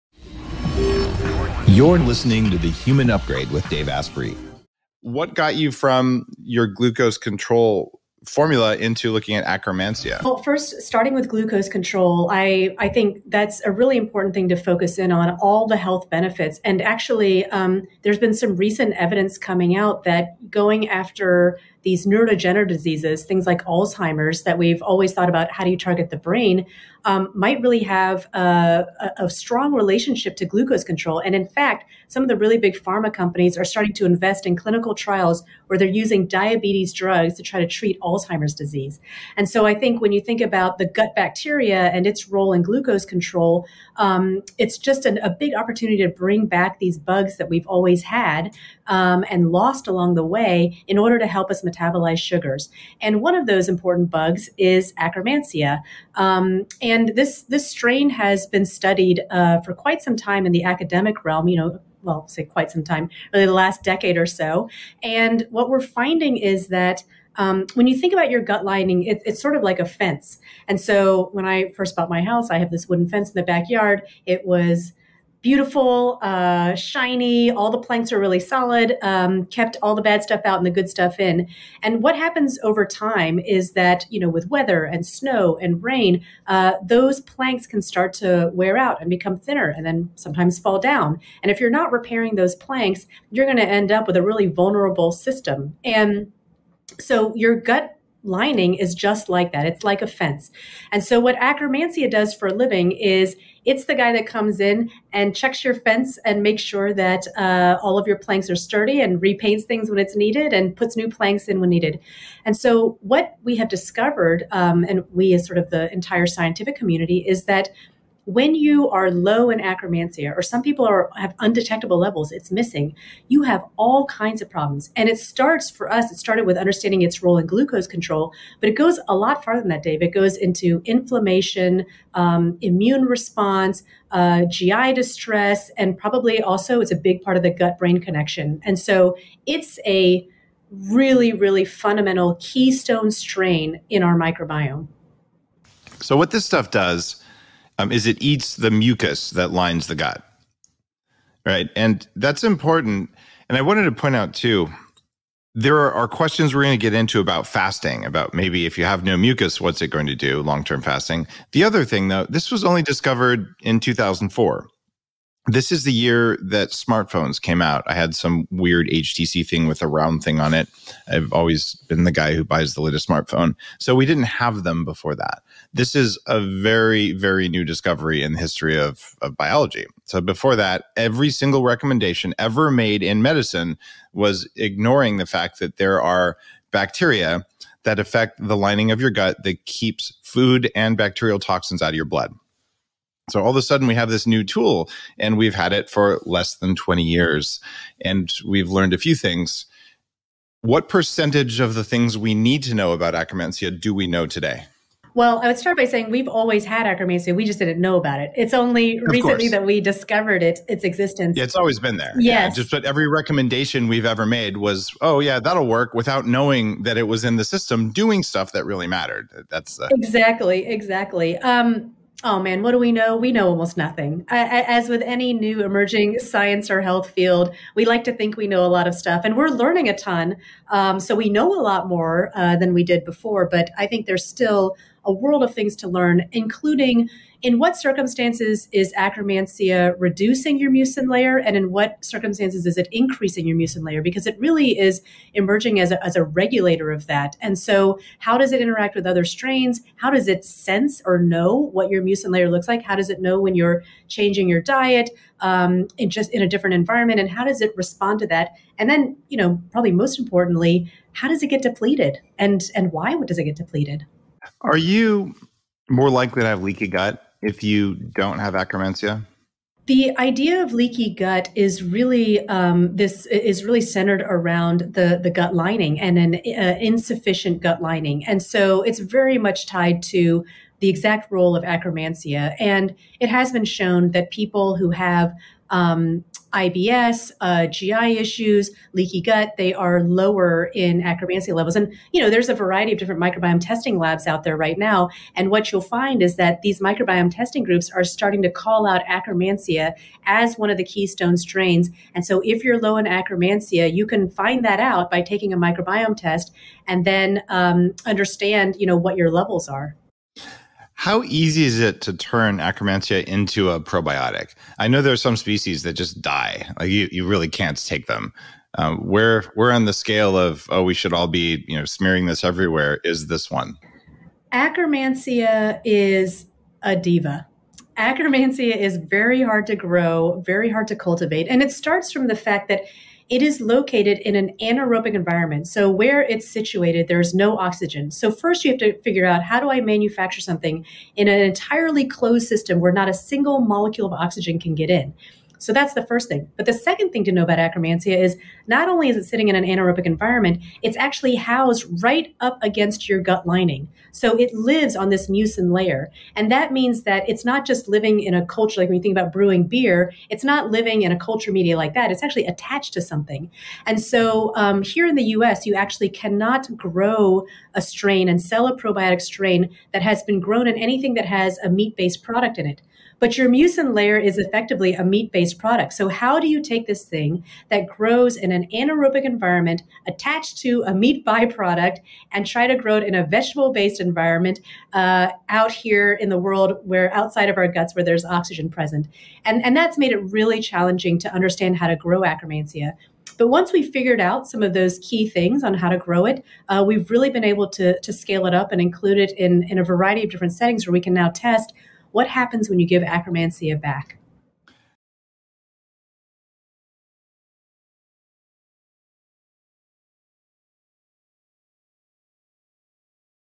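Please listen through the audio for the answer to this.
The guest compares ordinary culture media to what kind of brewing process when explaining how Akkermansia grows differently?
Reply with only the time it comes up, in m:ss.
5:59.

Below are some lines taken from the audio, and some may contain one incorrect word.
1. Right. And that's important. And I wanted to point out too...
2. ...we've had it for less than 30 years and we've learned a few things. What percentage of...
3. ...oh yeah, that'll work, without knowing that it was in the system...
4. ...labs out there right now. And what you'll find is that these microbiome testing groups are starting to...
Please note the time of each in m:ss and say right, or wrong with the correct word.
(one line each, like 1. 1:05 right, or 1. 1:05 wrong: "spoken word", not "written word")
1. 2:31 right
2. 3:15 wrong: "20", not "30"
3. 3:35 right
4. 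4:53 right.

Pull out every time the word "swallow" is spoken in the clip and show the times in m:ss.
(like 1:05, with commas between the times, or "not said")
not said.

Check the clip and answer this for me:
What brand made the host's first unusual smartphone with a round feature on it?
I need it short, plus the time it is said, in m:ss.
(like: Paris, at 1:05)
HTC, at 2:48.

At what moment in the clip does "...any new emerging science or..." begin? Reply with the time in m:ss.
3:45.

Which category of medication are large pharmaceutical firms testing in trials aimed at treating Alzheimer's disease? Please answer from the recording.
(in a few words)
Diabetes drugs.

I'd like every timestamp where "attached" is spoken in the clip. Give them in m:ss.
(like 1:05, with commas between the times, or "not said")
6:02, 6:20.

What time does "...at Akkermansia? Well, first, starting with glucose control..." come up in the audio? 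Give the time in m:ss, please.
0:09.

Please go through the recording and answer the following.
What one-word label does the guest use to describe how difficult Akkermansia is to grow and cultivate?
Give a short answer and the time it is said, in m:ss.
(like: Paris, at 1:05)
A diva, at 5:26.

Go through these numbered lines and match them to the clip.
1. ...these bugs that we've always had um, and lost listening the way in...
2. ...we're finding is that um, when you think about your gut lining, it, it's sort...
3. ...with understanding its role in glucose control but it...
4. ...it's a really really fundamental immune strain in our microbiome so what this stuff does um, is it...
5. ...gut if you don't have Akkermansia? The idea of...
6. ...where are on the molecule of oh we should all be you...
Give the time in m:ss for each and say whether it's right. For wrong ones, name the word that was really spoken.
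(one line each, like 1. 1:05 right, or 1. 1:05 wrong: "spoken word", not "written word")
1. 0:46 wrong: "along", not "listening"
2. 1:05 right
3. 2:06 right
4. 2:19 wrong: "keystone", not "immune"
5. 4:26 right
6. 5:18 wrong: "scale", not "molecule".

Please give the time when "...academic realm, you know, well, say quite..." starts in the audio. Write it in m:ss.
1:00.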